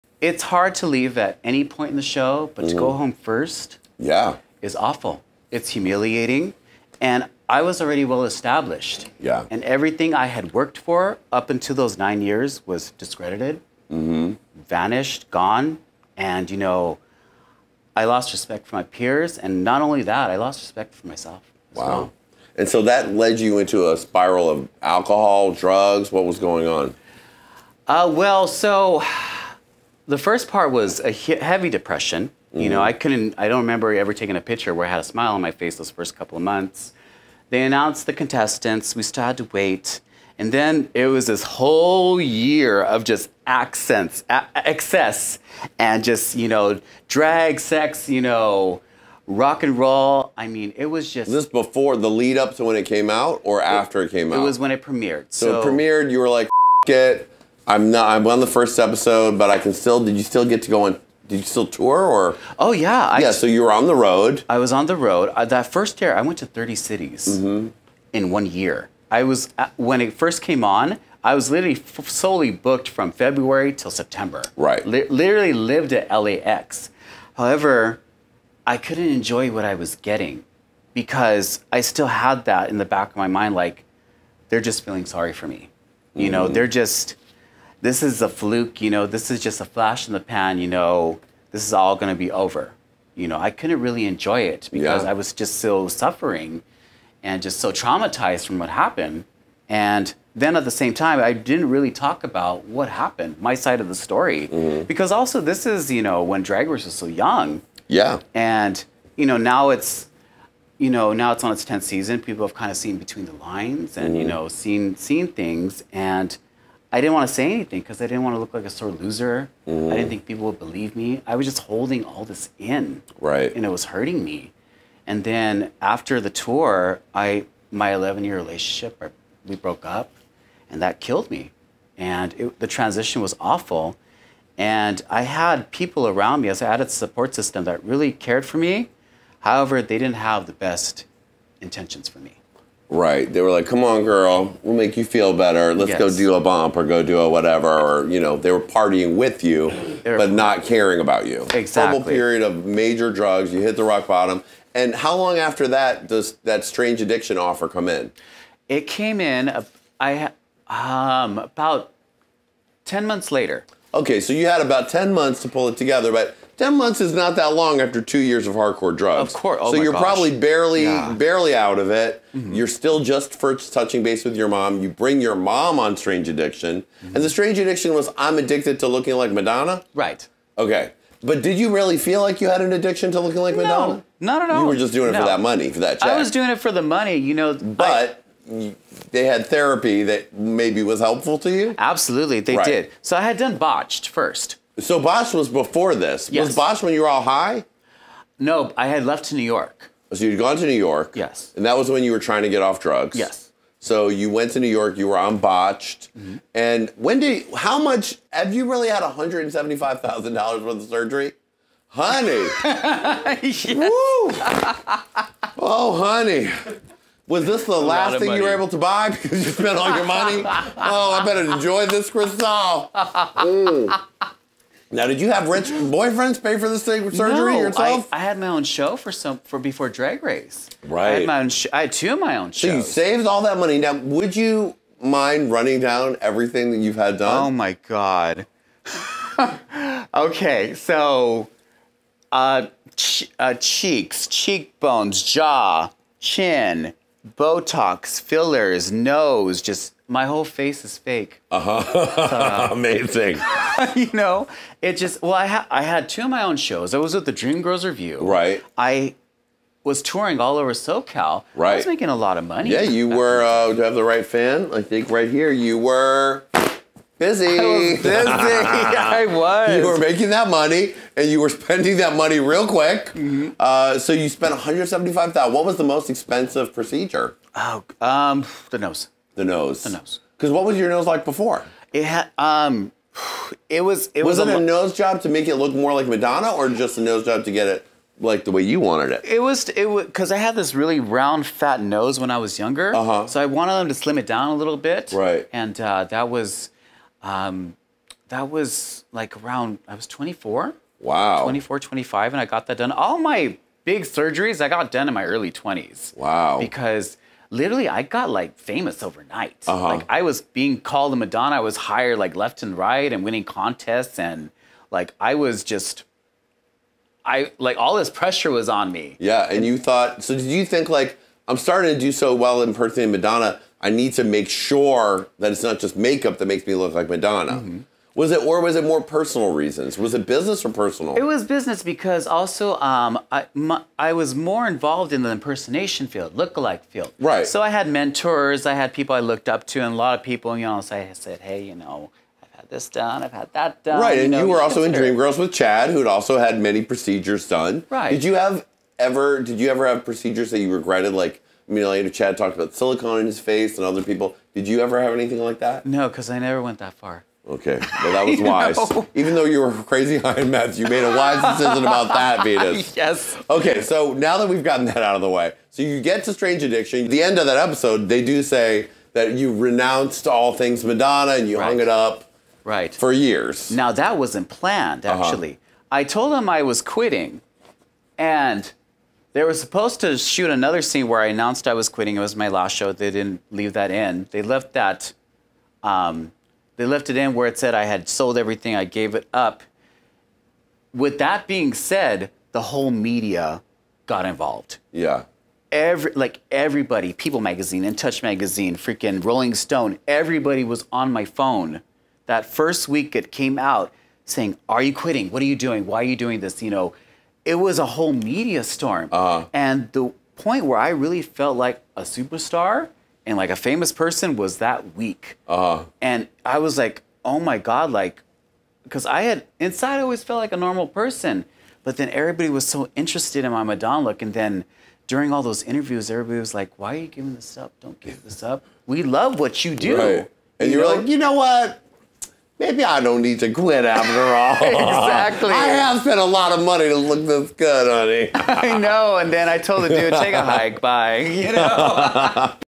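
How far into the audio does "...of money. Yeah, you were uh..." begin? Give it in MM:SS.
04:22.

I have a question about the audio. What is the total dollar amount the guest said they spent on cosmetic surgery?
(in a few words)
$175,000.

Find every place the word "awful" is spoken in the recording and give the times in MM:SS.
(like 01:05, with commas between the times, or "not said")
00:04, 02:13.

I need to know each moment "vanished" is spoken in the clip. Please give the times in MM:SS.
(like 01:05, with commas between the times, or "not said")
00:14.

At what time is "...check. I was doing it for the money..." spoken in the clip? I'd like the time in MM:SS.
03:05.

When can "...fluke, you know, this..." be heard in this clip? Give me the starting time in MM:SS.
01:28.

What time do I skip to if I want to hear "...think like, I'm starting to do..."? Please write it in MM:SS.
05:20.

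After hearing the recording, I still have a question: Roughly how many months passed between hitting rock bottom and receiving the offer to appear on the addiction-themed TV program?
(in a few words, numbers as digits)
10 months.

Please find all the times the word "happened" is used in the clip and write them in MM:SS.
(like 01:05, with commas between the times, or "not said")
01:38, 01:42.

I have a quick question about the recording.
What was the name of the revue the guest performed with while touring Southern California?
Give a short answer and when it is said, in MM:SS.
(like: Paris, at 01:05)
Dreamgirls Revue, at 04:17.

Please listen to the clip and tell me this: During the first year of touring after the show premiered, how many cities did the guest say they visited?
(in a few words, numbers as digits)
30.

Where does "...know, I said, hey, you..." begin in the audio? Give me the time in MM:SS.
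05:40.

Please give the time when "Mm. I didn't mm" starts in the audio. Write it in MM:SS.
01:59.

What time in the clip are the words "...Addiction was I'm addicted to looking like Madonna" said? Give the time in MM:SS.
02:57.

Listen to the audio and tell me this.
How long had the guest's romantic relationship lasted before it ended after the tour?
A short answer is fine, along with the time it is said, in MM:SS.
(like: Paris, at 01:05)
11 years, at 02:07.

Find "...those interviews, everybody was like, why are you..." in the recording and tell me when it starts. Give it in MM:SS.
07:05.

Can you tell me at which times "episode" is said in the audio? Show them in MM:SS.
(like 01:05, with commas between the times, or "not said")
00:58, 06:07.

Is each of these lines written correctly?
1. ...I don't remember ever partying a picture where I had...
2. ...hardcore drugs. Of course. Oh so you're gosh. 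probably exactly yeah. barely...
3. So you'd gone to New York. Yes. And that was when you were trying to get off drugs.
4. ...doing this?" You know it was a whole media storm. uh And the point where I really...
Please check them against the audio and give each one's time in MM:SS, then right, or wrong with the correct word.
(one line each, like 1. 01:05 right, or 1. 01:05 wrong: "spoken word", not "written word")
1. 00:33 wrong: "taking", not "partying"
2. 02:48 wrong: "barely", not "exactly"
3. 03:20 right
4. 06:46 right.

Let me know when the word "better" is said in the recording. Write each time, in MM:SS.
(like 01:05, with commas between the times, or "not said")
02:25, 03:41.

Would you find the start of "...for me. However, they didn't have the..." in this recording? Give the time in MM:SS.
02:18.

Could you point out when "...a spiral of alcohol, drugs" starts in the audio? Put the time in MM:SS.
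00:23.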